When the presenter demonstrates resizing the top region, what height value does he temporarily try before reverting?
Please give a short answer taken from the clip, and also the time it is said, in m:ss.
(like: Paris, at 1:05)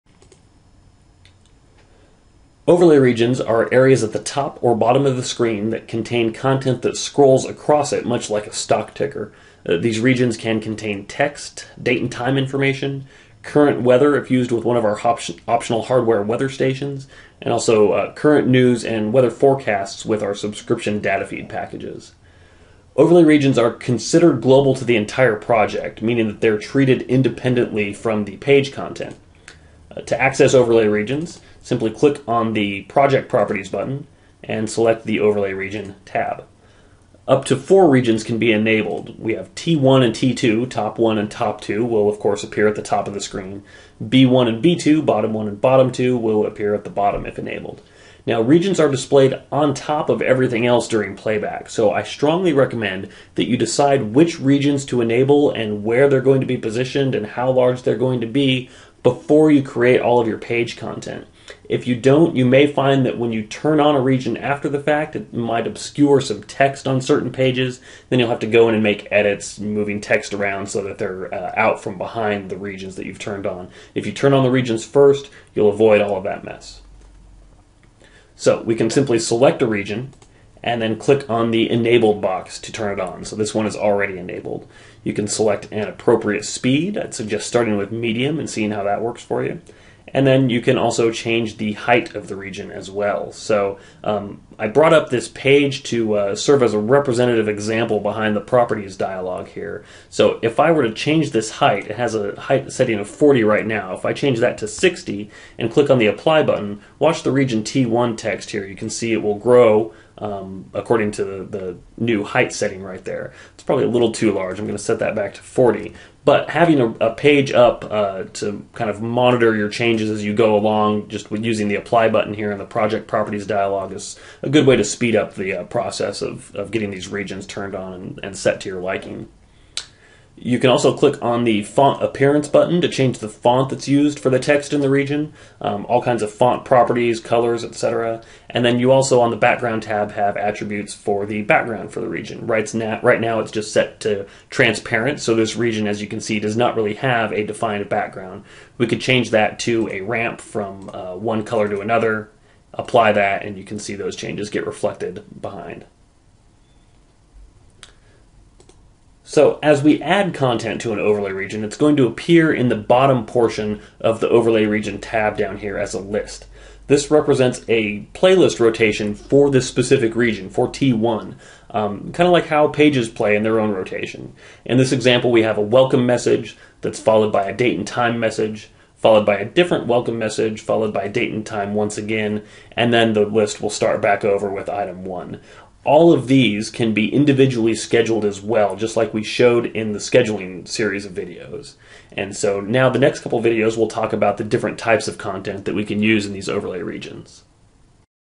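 60, at 1:44.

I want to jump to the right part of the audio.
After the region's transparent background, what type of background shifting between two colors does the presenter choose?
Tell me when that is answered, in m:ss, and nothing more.
2:29.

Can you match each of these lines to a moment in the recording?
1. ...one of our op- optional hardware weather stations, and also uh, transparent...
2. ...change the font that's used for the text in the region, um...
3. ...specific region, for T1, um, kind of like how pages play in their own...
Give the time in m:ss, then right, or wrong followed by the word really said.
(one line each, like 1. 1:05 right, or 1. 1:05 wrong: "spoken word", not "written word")
1. 0:14 wrong: "current", not "transparent"
2. 2:12 right
3. 2:49 right.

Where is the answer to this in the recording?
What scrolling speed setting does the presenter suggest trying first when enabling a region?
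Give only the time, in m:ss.
1:27.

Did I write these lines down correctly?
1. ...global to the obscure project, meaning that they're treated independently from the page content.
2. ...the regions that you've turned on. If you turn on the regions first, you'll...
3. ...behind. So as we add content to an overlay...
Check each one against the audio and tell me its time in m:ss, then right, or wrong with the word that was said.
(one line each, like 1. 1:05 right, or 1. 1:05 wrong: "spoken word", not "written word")
1. 0:24 wrong: "entire", not "obscure"
2. 1:12 right
3. 2:35 right.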